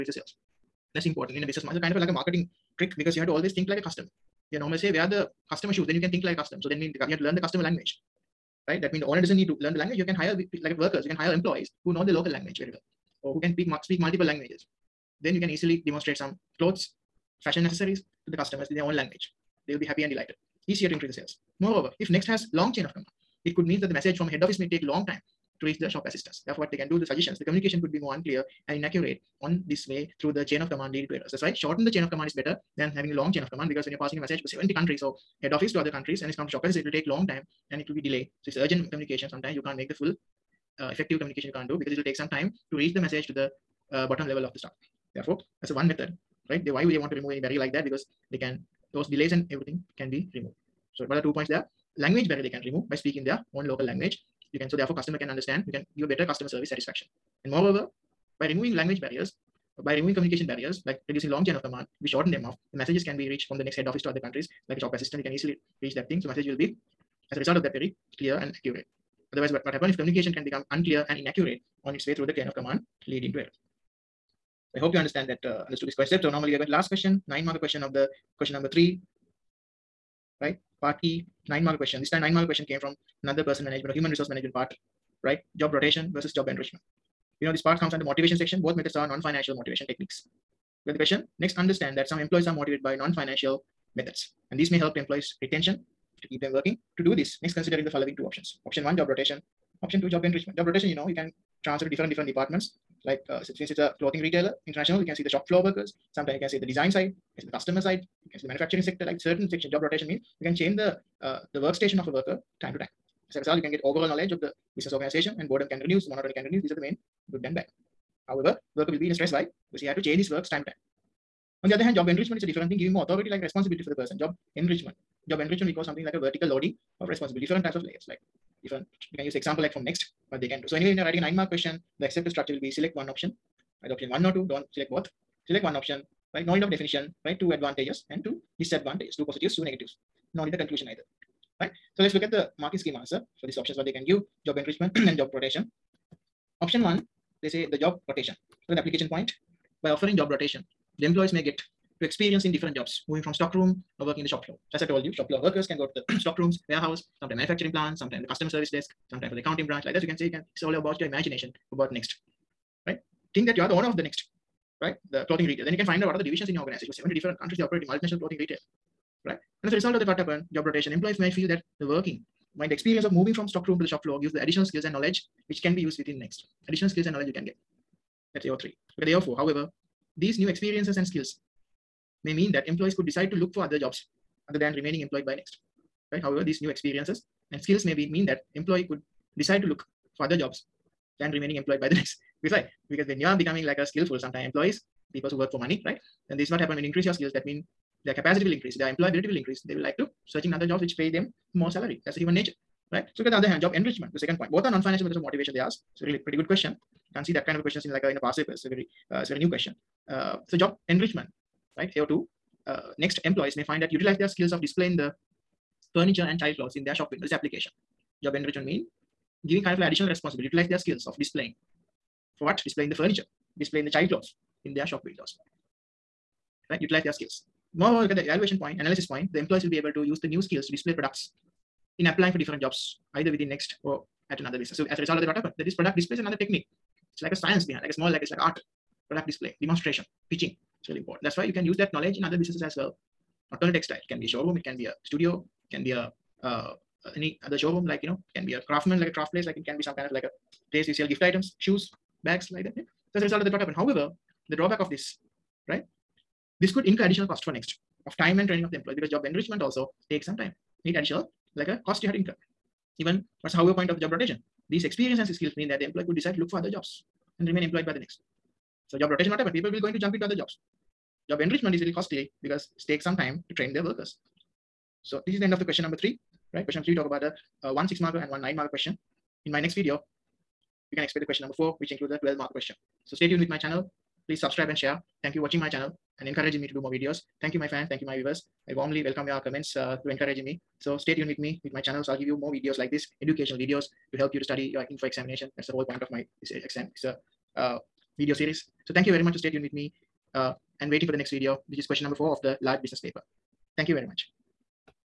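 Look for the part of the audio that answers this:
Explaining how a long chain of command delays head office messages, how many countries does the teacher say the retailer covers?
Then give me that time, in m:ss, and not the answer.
0:34.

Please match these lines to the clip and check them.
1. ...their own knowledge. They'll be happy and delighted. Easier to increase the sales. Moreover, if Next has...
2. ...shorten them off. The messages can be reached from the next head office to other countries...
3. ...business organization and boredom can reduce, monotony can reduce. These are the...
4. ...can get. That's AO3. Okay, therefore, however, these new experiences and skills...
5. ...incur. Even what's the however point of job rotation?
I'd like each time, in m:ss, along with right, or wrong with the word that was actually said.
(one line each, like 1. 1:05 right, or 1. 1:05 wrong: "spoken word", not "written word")
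1. 0:18 wrong: "language", not "knowledge"
2. 1:02 right
3. 1:54 right
4. 2:57 right
5. 4:22 right.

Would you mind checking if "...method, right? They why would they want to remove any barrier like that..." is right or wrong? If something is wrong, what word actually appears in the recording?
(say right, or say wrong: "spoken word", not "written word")
right.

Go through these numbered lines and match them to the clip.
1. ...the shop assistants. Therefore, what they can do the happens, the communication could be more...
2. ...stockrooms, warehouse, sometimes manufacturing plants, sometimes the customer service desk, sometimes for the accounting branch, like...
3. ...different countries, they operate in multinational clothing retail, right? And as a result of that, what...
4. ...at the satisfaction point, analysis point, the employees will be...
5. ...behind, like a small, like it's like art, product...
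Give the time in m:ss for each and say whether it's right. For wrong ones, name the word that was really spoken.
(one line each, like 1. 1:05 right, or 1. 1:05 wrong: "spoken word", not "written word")
1. 0:25 wrong: "suggestions", not "happens"
2. 2:36 right
3. 2:47 right
4. 3:48 wrong: "evaluation", not "satisfaction"
5. 3:57 right.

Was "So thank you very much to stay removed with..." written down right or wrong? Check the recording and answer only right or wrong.
wrong.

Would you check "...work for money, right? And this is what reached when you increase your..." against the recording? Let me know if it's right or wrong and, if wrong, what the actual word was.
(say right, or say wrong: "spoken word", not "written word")
wrong: "happened", not "reached".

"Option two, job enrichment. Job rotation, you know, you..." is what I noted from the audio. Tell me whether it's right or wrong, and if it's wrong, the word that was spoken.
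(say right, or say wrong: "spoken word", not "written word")
right.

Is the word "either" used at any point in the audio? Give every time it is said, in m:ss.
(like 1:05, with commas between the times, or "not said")
2:13, 2:20, 3:53.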